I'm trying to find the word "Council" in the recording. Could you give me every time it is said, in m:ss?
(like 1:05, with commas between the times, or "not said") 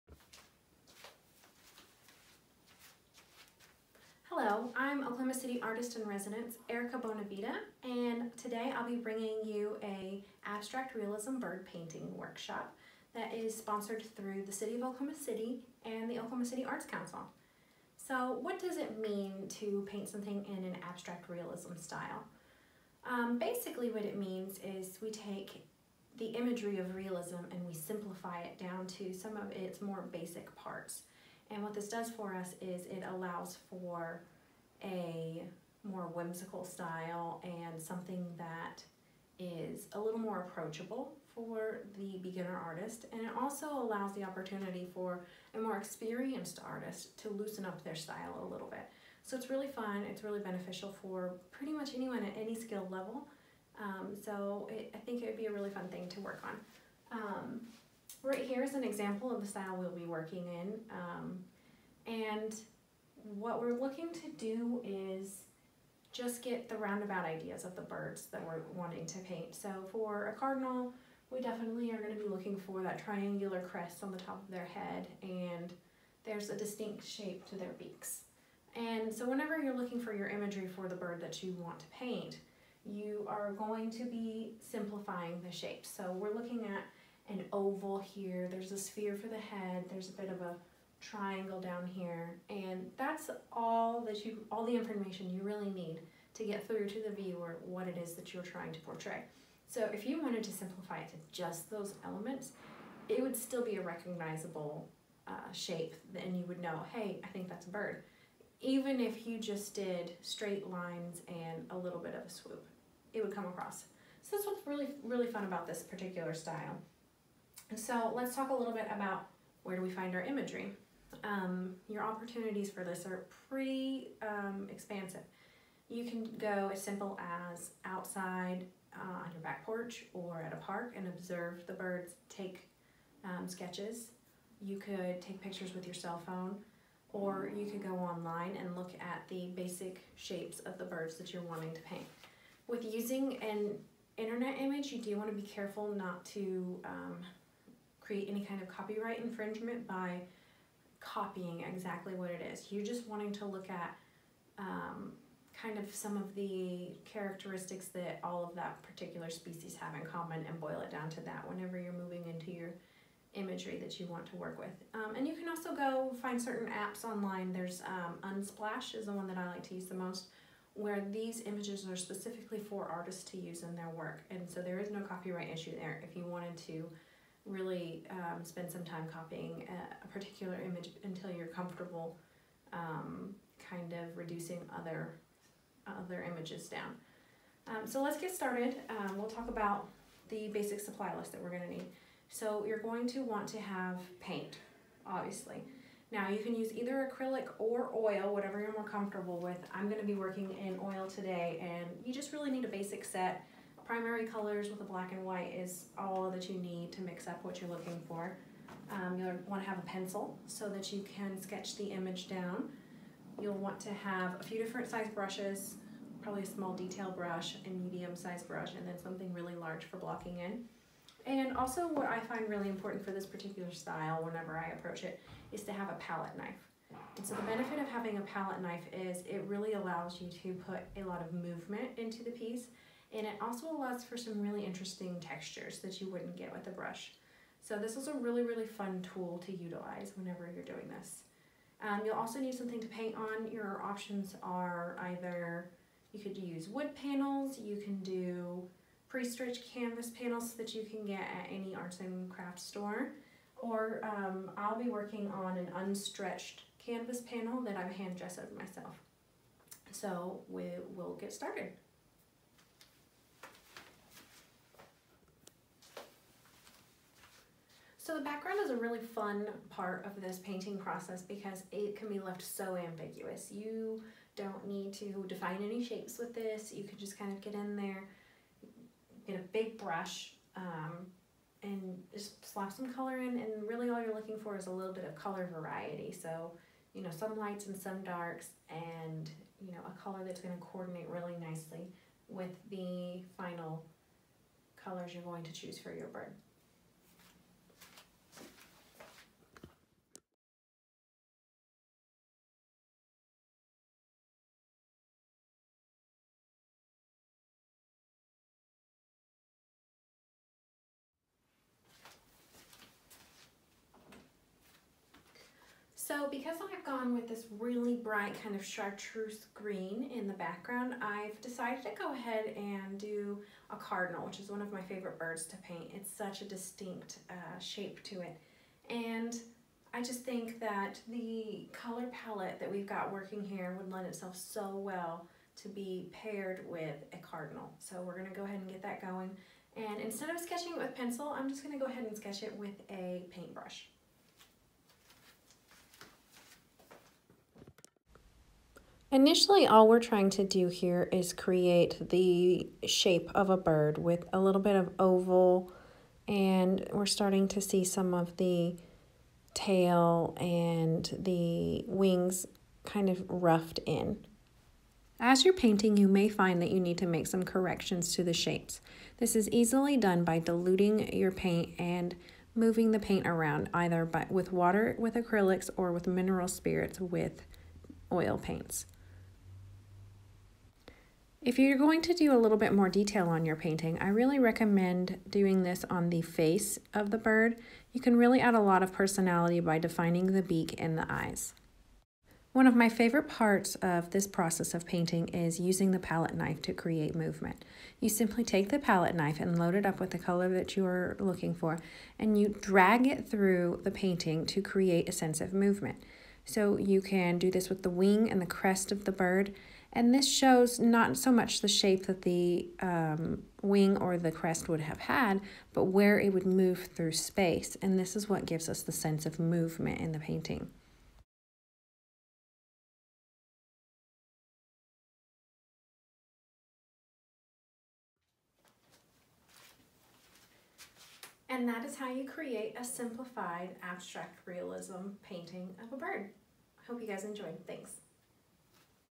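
0:16.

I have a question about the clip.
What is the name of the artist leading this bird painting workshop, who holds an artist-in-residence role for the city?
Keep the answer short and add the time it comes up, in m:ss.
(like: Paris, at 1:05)
Erica Bonavida, at 0:06.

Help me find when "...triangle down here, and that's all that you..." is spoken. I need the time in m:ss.
1:30.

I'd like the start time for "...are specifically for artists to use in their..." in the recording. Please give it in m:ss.
2:51.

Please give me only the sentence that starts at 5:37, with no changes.
So we're gonna go ahead and get that going.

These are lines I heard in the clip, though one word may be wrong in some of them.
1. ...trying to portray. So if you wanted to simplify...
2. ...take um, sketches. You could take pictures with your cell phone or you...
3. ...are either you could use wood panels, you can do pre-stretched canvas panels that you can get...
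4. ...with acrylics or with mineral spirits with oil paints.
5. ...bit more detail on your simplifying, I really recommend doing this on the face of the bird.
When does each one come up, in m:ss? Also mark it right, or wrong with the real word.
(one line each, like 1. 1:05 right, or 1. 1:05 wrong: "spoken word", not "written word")
1. 1:38 right
2. 2:12 right
3. 4:04 right
4. 6:14 right
5. 6:22 wrong: "painting", not "simplifying".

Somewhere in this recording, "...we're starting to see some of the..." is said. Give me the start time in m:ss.
5:56.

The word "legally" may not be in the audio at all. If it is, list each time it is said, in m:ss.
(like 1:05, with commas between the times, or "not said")
not said.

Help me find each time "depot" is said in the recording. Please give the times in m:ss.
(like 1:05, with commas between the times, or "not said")
not said.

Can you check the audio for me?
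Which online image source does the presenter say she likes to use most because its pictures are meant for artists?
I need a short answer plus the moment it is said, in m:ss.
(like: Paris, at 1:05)
Unsplash, at 2:48.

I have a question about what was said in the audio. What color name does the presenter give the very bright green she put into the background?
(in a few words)
Chartreuse.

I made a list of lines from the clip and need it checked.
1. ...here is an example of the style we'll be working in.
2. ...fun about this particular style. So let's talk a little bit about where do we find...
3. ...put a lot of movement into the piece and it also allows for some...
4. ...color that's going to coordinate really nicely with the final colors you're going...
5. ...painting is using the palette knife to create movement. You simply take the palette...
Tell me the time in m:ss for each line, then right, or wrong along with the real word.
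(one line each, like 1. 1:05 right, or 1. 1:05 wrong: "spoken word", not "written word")
1. 0:58 right
2. 1:55 right
3. 3:50 right
4. 4:50 right
5. 6:34 right.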